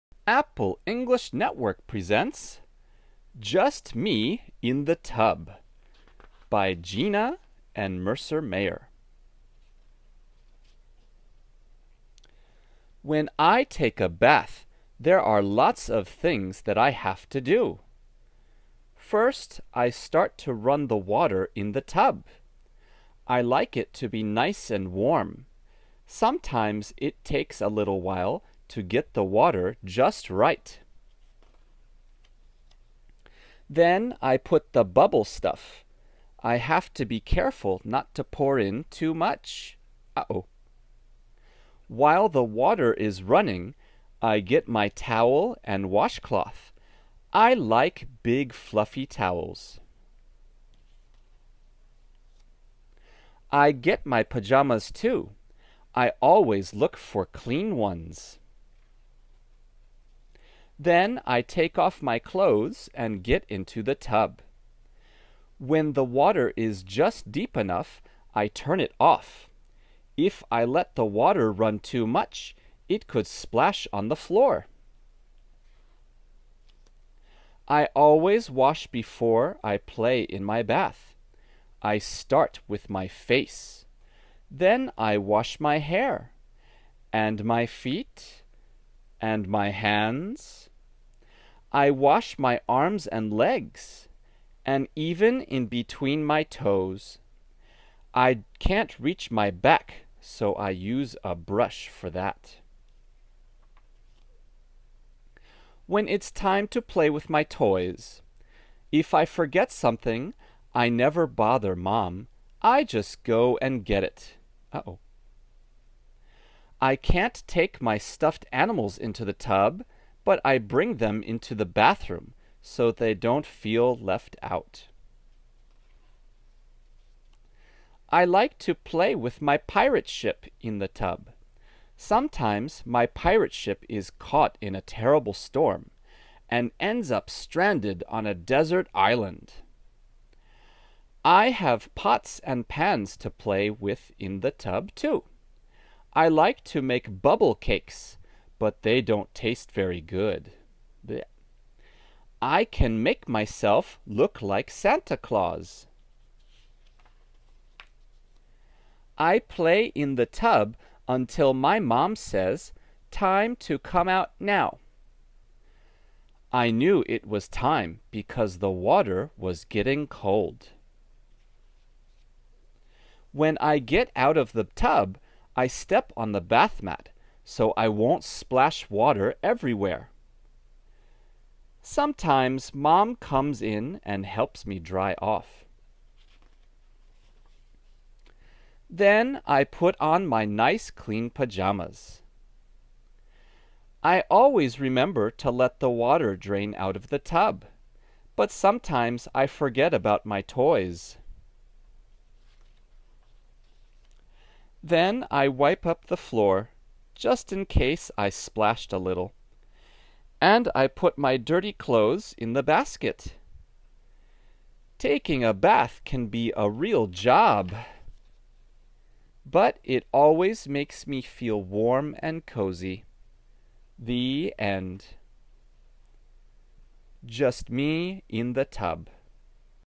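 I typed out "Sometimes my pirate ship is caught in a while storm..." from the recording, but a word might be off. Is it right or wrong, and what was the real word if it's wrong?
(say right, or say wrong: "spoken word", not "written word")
wrong: "terrible", not "while".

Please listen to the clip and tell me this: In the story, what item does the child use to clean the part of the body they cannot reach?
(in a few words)
A brush.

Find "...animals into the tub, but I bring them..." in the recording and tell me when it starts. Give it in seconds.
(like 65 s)
118 s.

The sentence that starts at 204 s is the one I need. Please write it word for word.
Then I wipe up the floor just in case I splashed a little.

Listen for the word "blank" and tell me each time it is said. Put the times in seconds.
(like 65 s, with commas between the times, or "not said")
not said.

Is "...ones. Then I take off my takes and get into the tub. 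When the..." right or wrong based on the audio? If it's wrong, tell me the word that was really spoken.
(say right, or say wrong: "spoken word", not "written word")
wrong: "clothes", not "takes".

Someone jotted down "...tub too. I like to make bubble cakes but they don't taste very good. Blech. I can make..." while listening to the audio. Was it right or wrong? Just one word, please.
right.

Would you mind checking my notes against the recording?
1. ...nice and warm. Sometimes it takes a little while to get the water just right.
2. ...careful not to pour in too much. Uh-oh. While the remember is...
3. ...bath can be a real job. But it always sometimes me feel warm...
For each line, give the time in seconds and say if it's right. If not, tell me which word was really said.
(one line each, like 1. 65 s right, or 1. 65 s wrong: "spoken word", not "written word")
1. 24 s right
2. 37 s wrong: "water", not "remember"
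3. 215 s wrong: "makes", not "sometimes".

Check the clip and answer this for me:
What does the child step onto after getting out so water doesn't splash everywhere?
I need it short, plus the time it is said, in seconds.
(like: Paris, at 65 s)
The bath mat, at 176 s.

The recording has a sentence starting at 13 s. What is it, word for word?
When I take a bath, there are lots of things that I have to do.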